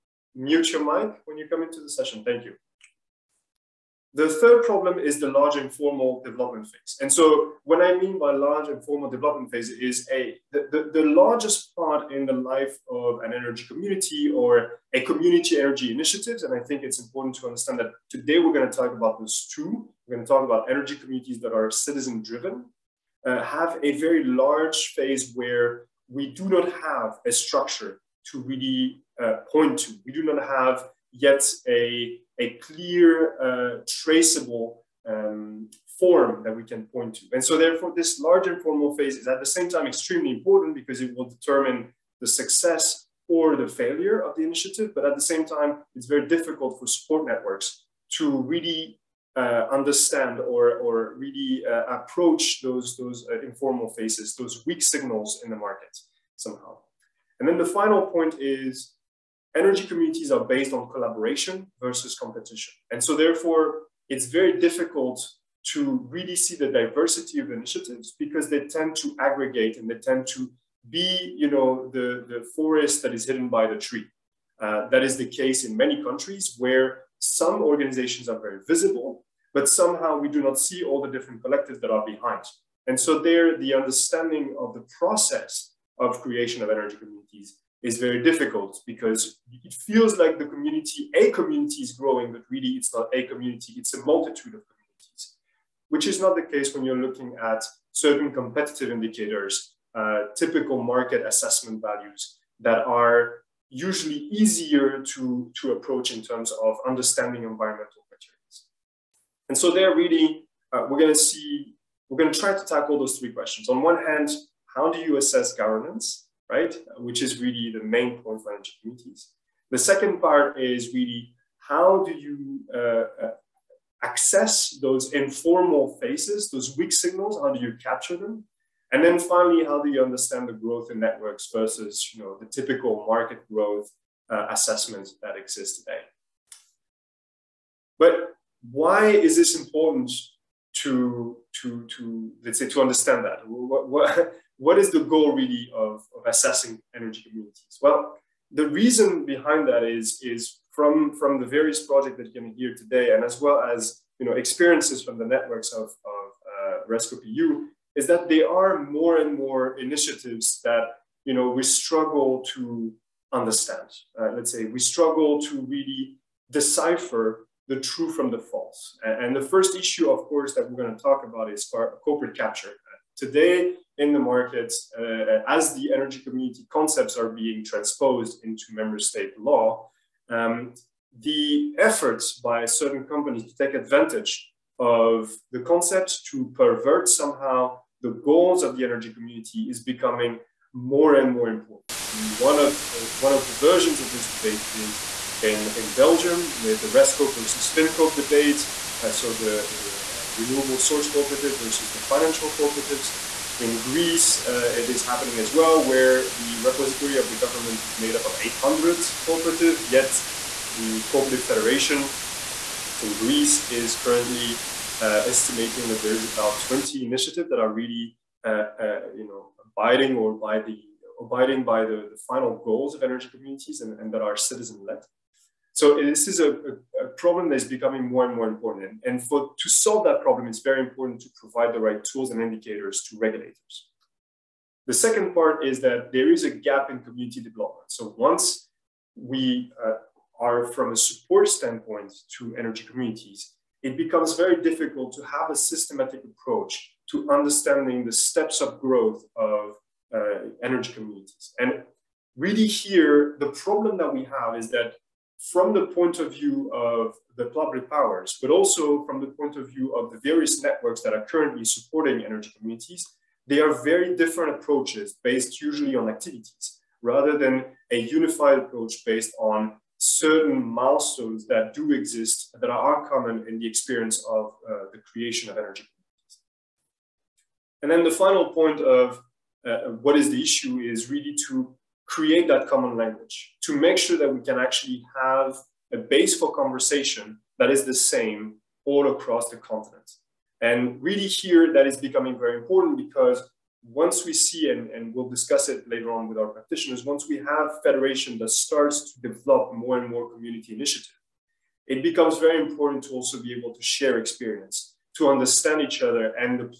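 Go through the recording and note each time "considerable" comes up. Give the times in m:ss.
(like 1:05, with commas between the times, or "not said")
not said.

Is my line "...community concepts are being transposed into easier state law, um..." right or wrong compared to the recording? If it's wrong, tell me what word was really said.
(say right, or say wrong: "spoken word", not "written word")
wrong: "member", not "easier".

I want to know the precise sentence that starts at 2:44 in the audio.
Uh, let's say we struggle to really decipher the true from the false.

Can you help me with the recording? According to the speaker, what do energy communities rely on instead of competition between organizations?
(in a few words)
Collaboration.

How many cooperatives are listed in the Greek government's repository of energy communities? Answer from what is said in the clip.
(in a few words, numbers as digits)
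800.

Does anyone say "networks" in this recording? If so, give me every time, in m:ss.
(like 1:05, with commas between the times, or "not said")
0:47, 2:11, 2:35, 4:20.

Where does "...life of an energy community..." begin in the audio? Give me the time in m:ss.
0:12.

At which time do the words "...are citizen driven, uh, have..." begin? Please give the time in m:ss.
0:21.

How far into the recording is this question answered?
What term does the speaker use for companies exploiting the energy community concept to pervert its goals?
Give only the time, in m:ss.
2:52.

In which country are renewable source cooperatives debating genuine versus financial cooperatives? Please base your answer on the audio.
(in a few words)
Belgium.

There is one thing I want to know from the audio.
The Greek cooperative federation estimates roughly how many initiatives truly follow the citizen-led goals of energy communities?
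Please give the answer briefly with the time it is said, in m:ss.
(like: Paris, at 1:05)
20, at 3:36.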